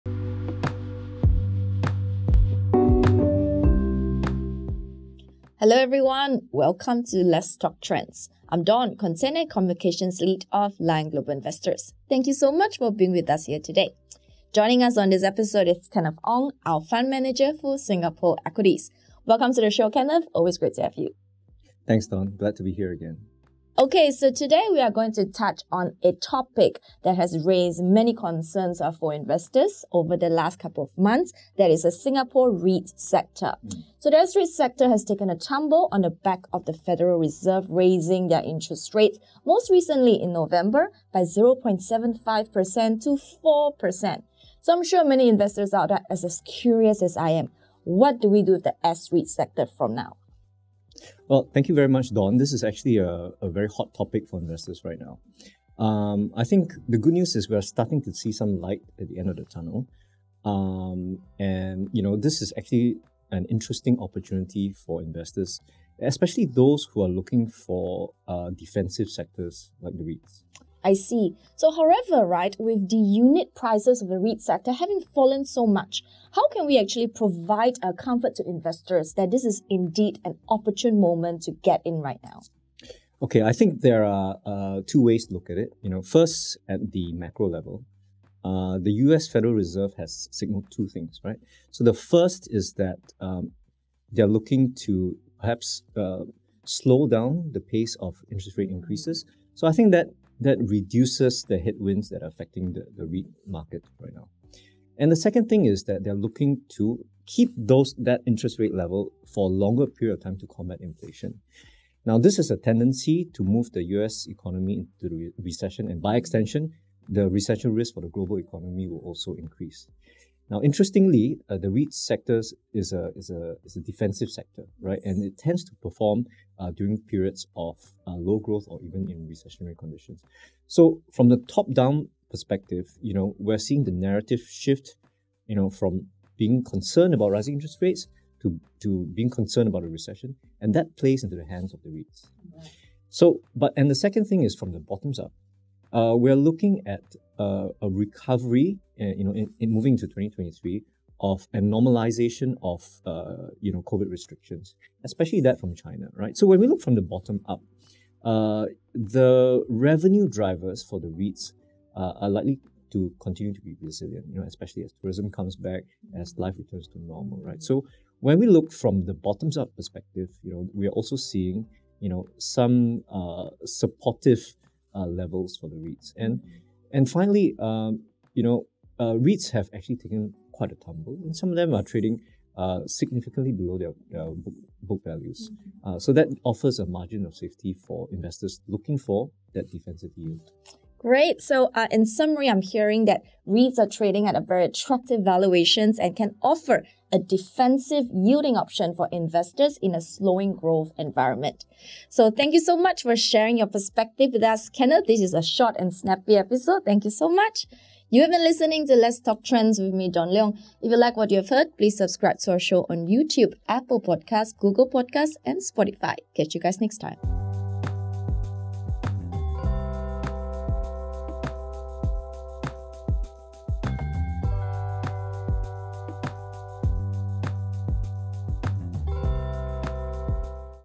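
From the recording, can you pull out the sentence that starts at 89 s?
Federal Reserve has signaled two things, right?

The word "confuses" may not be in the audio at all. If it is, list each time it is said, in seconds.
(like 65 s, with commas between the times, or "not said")
not said.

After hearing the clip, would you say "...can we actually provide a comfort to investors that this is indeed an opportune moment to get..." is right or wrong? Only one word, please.
right.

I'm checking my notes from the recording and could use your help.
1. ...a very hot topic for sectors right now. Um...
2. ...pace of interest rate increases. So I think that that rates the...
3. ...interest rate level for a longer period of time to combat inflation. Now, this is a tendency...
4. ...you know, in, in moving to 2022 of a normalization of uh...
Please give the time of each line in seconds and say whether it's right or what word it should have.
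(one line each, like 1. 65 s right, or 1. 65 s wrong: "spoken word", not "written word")
1. 53 s wrong: "investors", not "sectors"
2. 97 s wrong: "reduces", not "rates"
3. 108 s right
4. 149 s wrong: "2023", not "2022".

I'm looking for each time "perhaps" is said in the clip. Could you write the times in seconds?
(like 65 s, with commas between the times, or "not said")
95 s.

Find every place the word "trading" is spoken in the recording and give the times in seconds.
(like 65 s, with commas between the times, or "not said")
181 s, 193 s.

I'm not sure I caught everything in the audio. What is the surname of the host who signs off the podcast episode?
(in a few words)
Leong.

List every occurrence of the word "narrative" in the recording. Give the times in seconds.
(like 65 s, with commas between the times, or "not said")
133 s.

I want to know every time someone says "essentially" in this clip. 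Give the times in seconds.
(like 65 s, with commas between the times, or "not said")
not said.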